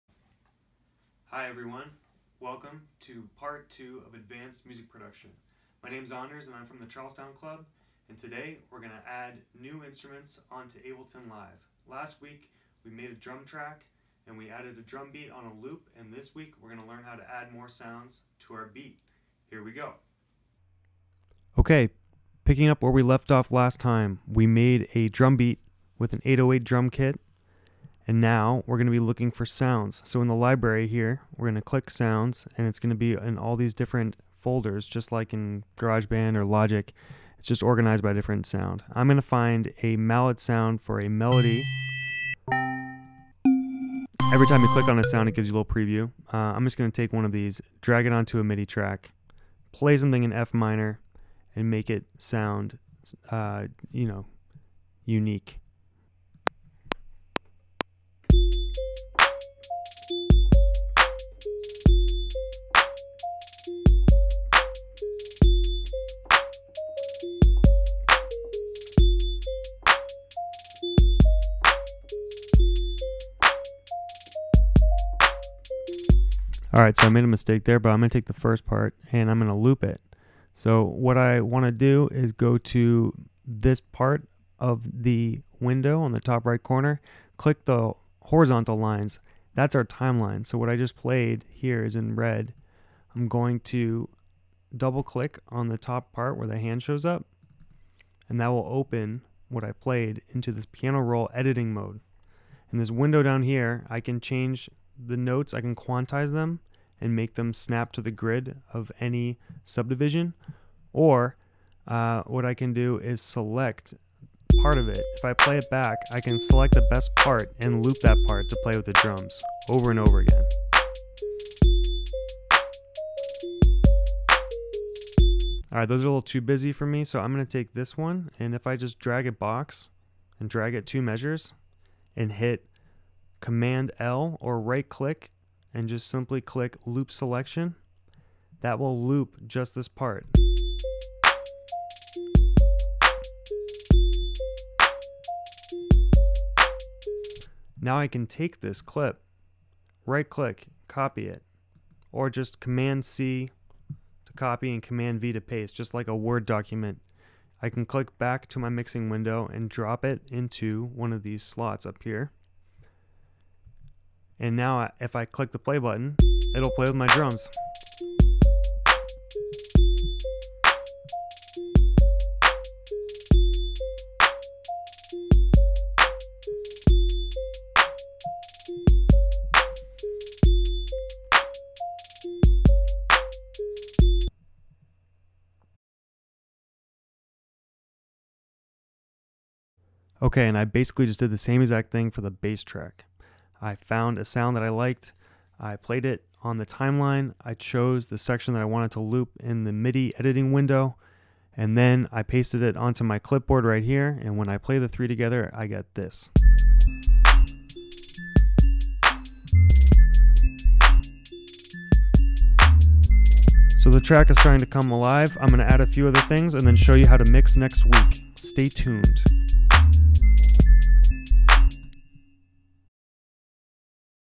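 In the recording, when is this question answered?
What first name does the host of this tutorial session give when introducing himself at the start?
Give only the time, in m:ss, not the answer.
0:06.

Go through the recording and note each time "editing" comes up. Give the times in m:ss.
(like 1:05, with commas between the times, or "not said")
1:41, 3:20.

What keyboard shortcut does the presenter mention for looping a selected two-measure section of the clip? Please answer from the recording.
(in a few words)
Command L.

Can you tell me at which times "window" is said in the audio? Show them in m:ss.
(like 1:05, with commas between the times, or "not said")
1:25, 1:42, 2:39, 3:20.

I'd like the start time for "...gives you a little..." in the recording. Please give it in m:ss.
0:45.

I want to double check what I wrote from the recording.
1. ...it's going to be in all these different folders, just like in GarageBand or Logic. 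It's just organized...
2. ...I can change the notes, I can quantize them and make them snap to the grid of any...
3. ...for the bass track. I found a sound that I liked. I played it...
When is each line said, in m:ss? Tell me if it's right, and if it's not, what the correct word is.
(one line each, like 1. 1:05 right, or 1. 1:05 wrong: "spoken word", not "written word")
1. 0:32 right
2. 1:43 right
3. 3:12 right.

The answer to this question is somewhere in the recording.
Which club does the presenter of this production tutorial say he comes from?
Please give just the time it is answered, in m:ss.
0:06.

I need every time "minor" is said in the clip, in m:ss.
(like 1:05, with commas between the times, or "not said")
0:50.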